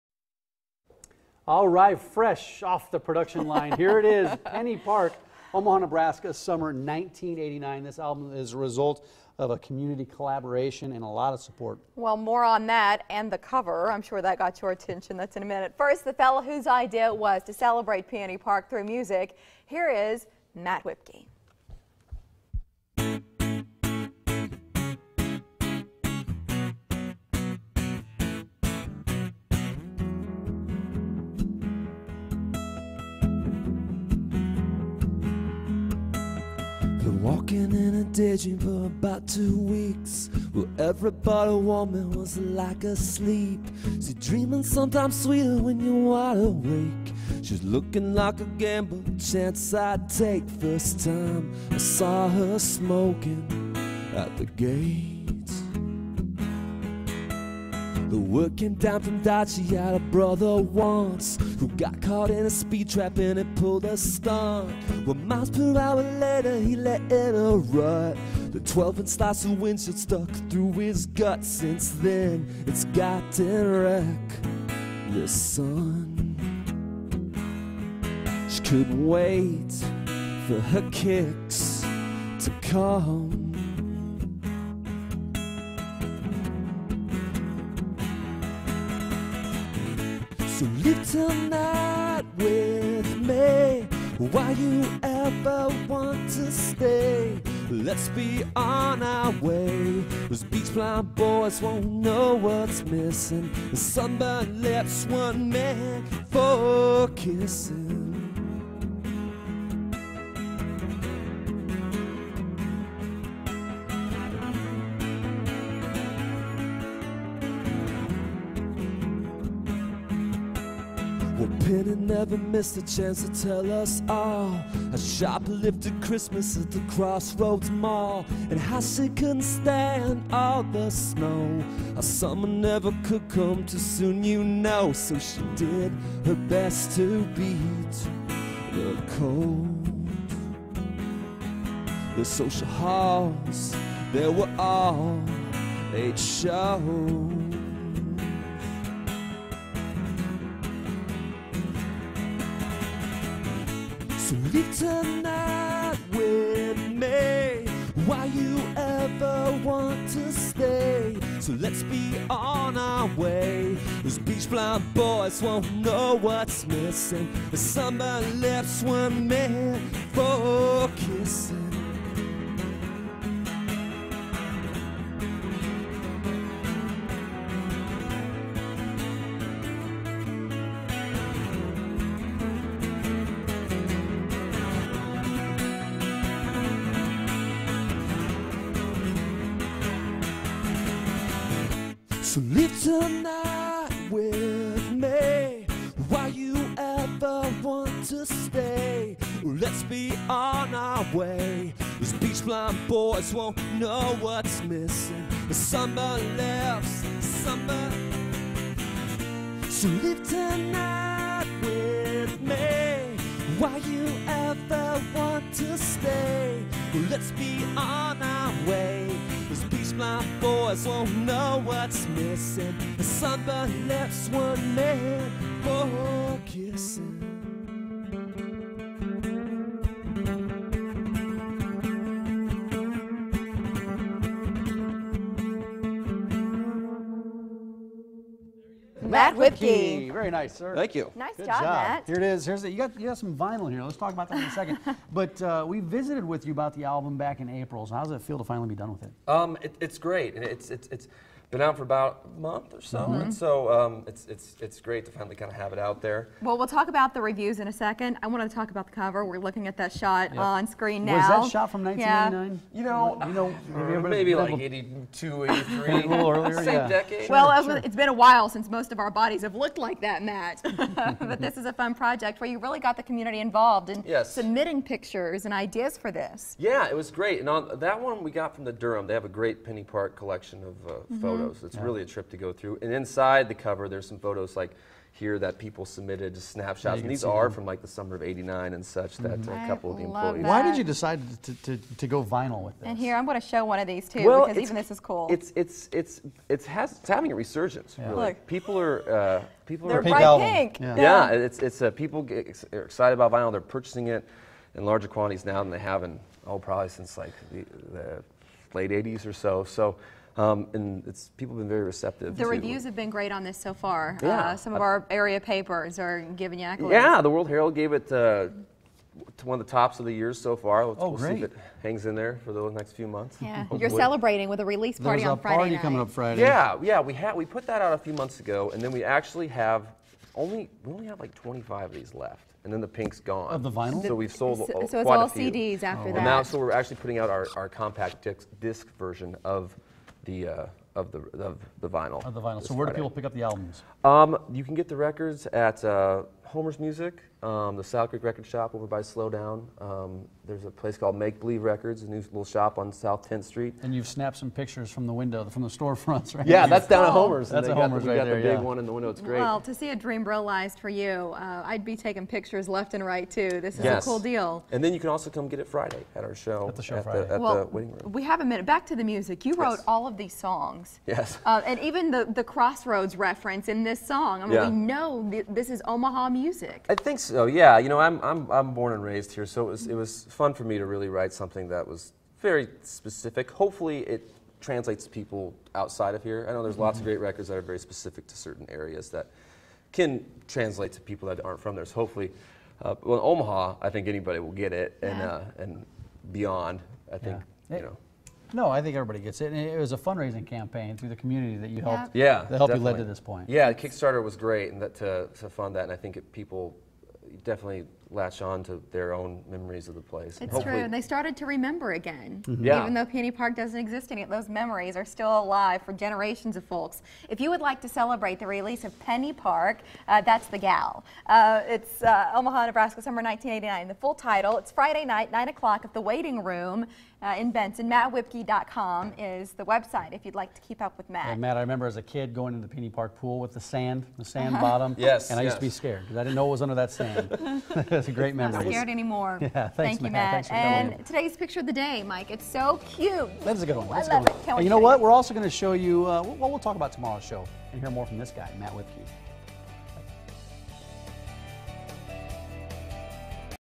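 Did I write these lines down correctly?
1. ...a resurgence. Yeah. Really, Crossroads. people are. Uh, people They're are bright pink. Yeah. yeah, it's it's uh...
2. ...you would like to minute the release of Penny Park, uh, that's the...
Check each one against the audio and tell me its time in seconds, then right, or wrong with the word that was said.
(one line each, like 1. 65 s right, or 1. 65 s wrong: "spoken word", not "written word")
1. 297 s wrong: "Look", not "Crossroads"
2. 417 s wrong: "celebrate", not "minute".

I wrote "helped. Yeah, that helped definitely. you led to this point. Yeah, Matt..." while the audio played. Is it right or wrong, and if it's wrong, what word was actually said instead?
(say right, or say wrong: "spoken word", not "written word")
wrong: "Kickstarter", not "Matt".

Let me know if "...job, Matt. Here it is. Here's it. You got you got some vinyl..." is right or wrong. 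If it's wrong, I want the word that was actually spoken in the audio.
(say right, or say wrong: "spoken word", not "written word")
right.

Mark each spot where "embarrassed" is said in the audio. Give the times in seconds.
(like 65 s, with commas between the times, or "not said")
not said.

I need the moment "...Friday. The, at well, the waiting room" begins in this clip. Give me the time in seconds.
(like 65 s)
367 s.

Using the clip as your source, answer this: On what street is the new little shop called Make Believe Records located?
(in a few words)
South 10th Street.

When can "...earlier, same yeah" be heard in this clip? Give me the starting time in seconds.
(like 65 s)
266 s.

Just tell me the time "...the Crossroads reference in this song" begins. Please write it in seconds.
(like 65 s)
372 s.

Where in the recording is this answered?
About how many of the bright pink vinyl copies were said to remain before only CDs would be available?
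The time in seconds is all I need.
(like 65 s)
331 s.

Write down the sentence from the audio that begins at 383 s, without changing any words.
Hopefully, it translates to people outside of here.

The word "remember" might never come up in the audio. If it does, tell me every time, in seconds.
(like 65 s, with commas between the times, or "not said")
411 s, 431 s.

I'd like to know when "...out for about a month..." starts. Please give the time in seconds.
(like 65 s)
251 s.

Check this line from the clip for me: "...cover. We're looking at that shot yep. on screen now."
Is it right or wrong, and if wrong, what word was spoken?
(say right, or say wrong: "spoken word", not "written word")
right.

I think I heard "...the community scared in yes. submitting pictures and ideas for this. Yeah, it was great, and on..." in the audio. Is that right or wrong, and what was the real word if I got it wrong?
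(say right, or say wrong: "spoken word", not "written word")
wrong: "involved", not "scared".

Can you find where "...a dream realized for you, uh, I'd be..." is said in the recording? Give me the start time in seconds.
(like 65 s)
359 s.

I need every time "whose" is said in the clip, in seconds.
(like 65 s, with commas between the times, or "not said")
16 s.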